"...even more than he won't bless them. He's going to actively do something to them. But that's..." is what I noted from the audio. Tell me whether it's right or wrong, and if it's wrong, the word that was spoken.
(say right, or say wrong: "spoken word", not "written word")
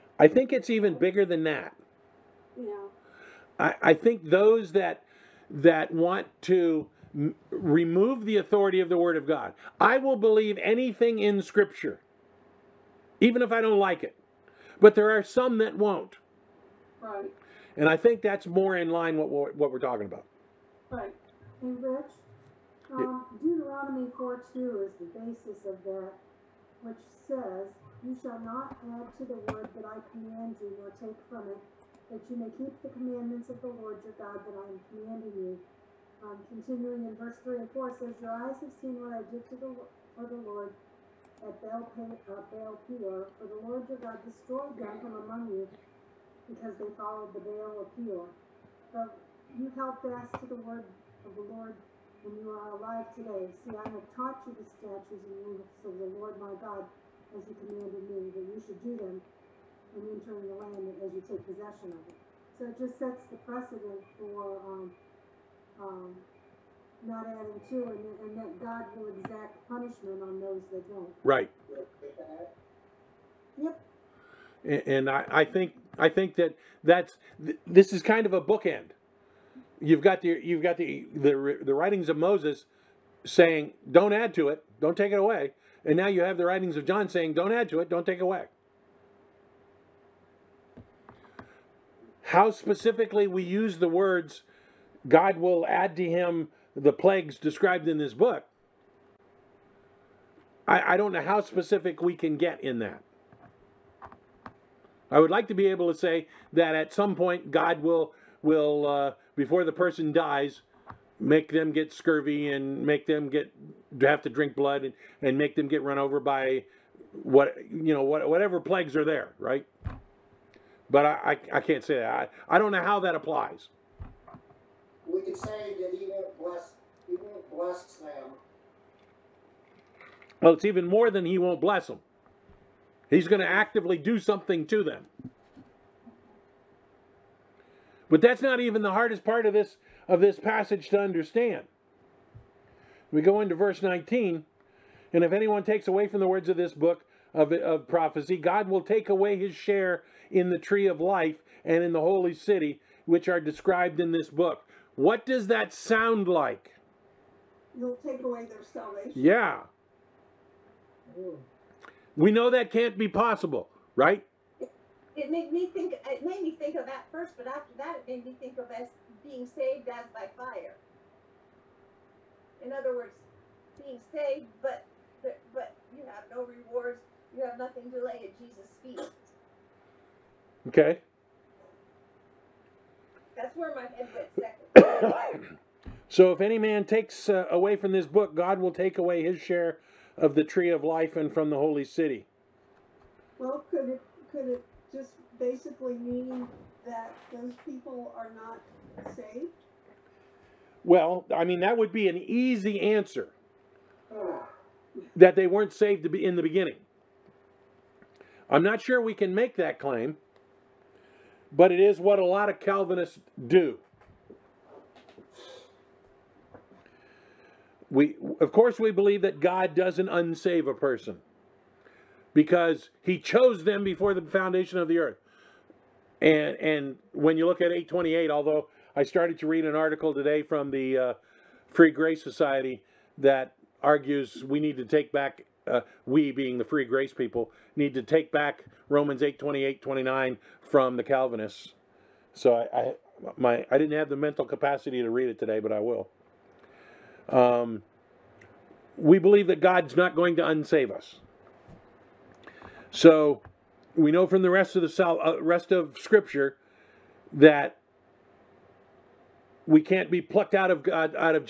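right.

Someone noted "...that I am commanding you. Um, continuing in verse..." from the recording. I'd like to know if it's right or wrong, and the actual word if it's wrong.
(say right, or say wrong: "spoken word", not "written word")
right.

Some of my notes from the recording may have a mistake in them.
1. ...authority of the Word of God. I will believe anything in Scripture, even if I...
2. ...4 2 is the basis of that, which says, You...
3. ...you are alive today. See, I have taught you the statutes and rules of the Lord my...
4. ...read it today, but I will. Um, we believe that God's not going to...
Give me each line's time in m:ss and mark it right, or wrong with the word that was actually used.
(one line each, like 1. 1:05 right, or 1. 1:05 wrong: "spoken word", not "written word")
1. 0:08 right
2. 0:24 right
3. 0:52 right
4. 4:05 right.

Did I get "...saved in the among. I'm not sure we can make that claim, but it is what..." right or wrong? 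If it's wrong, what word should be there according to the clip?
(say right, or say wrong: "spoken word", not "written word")
wrong: "beginning", not "among".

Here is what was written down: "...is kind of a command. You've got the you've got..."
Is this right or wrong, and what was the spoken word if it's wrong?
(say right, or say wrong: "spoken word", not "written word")
wrong: "bookend", not "command".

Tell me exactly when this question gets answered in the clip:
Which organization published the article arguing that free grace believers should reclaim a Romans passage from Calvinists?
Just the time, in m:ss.
3:51.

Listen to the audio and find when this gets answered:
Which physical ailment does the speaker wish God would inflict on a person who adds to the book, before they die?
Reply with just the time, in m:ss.
1:51.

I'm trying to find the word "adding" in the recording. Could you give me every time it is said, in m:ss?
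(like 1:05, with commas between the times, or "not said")
1:07.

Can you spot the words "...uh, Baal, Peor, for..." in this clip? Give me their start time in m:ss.
0:41.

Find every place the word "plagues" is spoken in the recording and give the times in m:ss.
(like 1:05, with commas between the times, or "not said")
1:36, 1:58.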